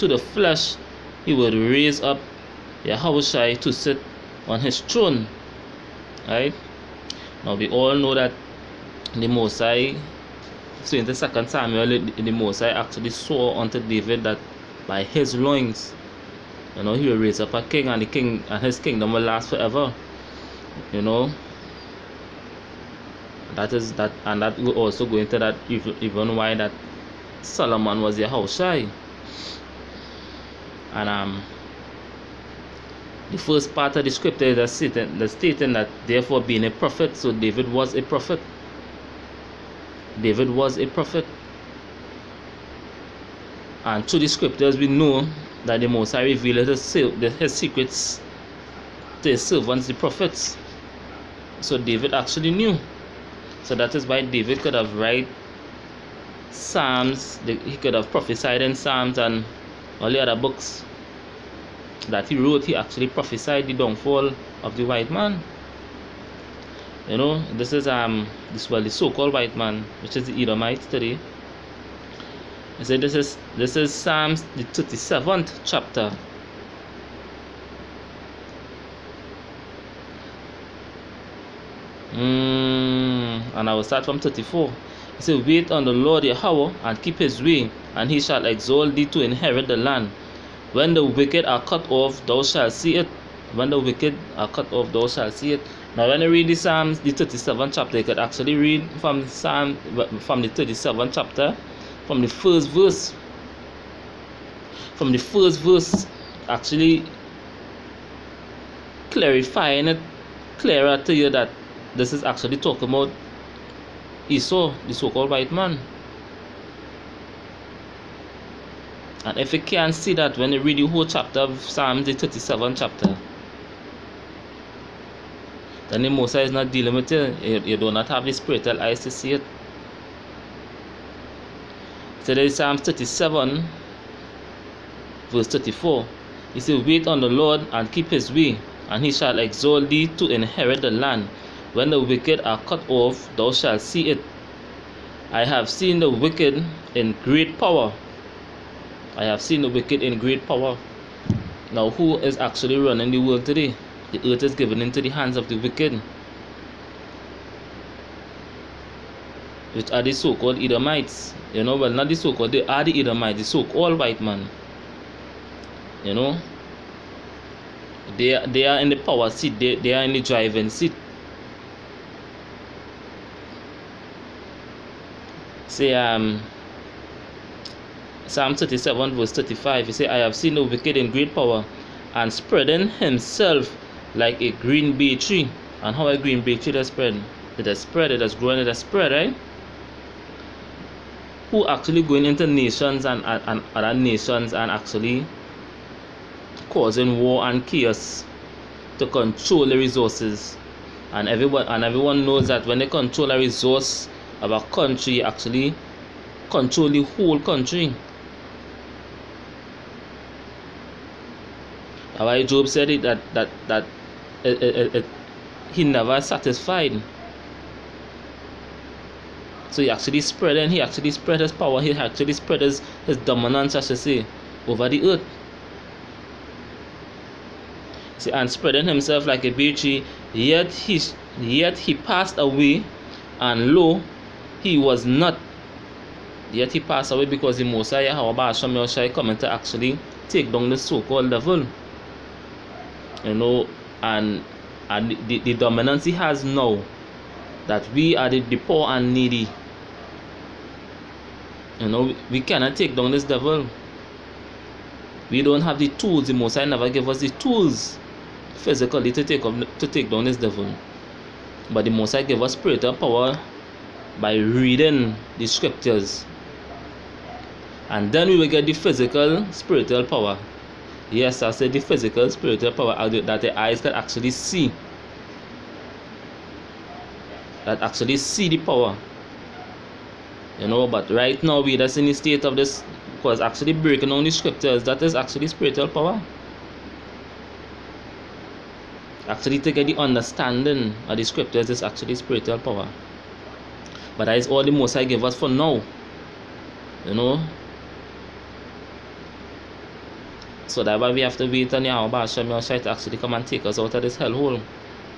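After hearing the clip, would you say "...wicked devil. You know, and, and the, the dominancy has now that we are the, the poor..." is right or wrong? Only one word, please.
wrong.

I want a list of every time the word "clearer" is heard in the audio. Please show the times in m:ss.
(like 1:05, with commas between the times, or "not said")
1:50.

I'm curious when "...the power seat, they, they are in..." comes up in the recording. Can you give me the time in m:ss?
2:48.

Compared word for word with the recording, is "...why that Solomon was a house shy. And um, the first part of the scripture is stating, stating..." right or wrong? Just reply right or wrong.
right.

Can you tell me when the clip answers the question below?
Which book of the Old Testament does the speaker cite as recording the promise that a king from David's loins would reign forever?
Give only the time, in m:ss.
0:11.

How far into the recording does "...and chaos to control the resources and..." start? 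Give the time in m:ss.
3:17.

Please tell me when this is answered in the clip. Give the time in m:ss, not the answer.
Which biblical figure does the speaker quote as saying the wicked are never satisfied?
3:32.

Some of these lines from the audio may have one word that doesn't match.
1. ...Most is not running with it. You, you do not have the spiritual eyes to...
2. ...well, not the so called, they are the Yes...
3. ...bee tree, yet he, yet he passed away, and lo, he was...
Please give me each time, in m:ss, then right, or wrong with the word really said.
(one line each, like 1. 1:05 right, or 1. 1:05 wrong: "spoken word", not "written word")
1. 2:06 wrong: "dealing", not "running"
2. 2:41 wrong: "Edomites", not "Yes"
3. 3:49 right.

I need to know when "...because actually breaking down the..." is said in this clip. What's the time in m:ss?
4:43.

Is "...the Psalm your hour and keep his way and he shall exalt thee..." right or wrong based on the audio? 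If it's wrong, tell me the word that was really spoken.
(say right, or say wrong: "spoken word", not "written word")
wrong: "Lord", not "Psalm".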